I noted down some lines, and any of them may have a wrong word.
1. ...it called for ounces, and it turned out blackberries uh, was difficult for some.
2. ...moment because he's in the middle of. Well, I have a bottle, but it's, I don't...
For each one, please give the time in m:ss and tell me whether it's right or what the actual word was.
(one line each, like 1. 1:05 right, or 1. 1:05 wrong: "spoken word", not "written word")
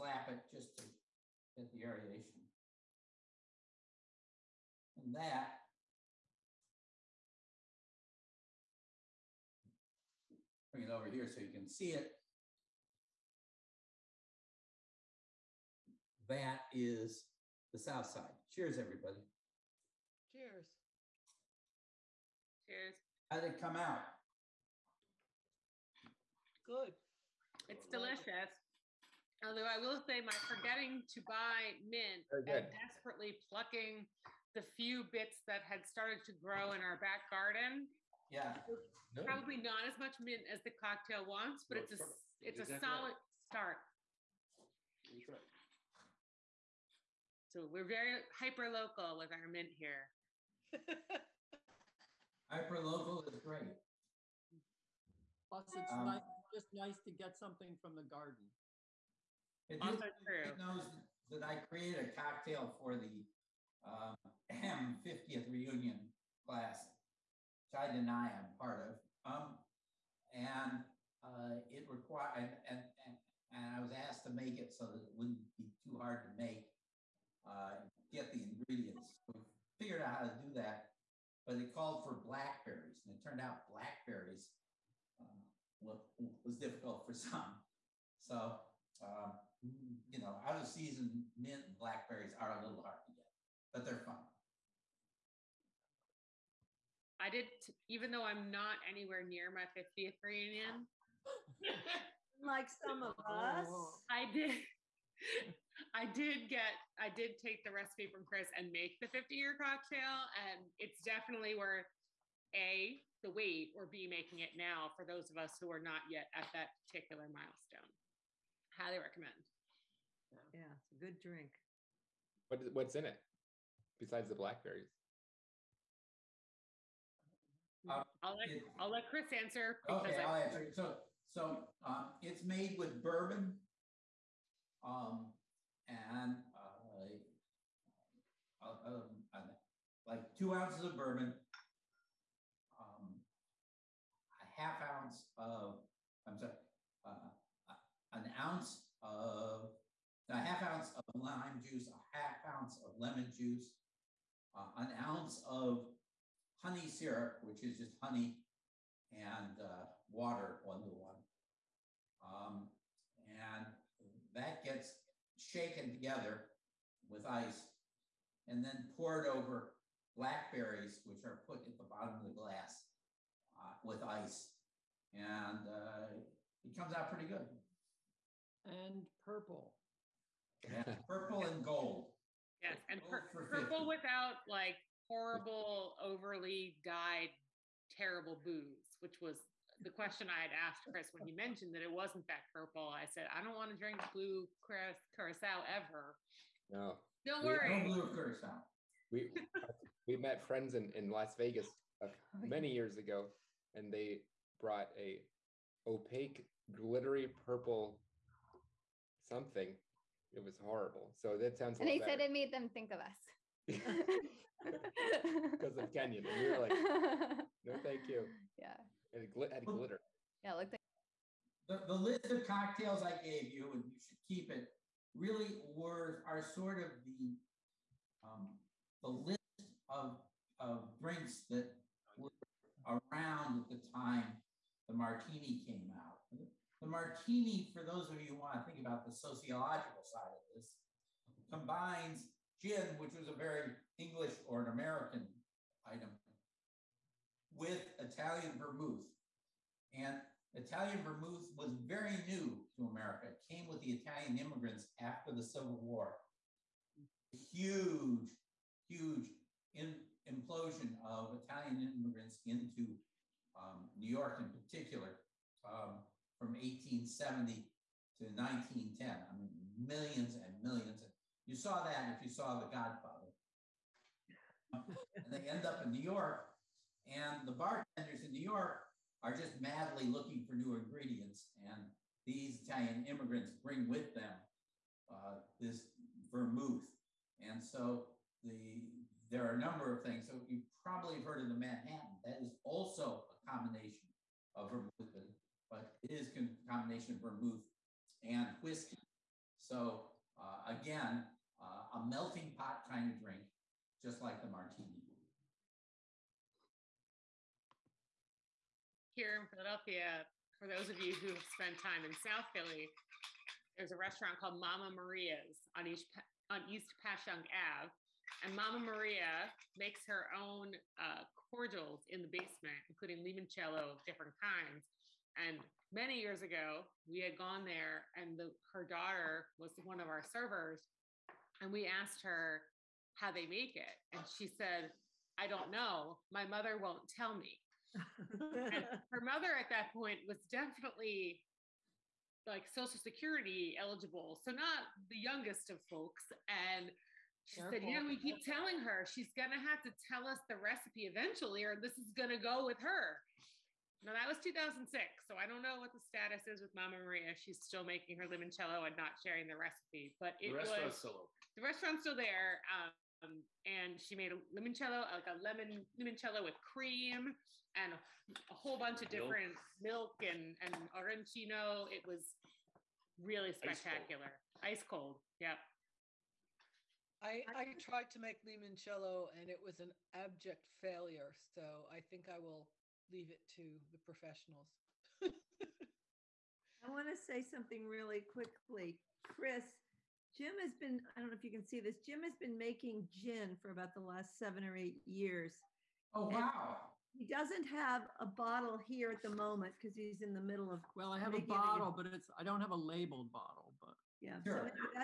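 1. 1:21 wrong: "blackberries", not "ounces"
2. 6:39 right.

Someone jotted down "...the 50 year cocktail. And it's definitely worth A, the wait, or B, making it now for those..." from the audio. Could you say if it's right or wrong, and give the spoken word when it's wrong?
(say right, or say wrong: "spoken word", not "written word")
right.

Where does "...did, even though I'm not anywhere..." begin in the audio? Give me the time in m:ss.
1:37.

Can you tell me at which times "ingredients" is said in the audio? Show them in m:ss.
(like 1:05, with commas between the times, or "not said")
1:18, 4:40.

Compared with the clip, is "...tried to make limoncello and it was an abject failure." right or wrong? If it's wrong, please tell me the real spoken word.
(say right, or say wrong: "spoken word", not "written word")
right.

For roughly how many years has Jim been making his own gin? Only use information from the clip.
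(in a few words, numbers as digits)
7 or 8 years.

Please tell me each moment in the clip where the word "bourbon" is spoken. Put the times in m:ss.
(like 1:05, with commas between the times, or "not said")
2:13, 2:20.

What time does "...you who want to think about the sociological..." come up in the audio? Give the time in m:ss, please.
3:58.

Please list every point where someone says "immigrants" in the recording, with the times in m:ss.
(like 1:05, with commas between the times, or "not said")
4:14, 4:21, 4:43.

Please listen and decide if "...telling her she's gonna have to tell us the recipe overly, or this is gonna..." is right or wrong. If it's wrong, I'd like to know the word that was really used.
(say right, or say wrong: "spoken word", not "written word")
wrong: "eventually", not "overly".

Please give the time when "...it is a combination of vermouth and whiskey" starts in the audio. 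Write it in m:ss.
4:56.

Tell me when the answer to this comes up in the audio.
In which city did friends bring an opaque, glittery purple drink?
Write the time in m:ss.
3:21.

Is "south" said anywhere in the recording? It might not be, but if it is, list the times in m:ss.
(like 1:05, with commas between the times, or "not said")
0:17, 5:12.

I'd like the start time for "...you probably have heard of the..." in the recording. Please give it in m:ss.
4:50.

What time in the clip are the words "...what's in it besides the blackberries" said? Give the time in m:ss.
2:02.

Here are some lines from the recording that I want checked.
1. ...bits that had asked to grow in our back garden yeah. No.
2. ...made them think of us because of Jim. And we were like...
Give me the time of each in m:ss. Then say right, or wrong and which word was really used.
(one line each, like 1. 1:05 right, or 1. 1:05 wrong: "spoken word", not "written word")
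1. 0:35 wrong: "started", not "asked"
2. 3:32 wrong: "Kenyon", not "Jim".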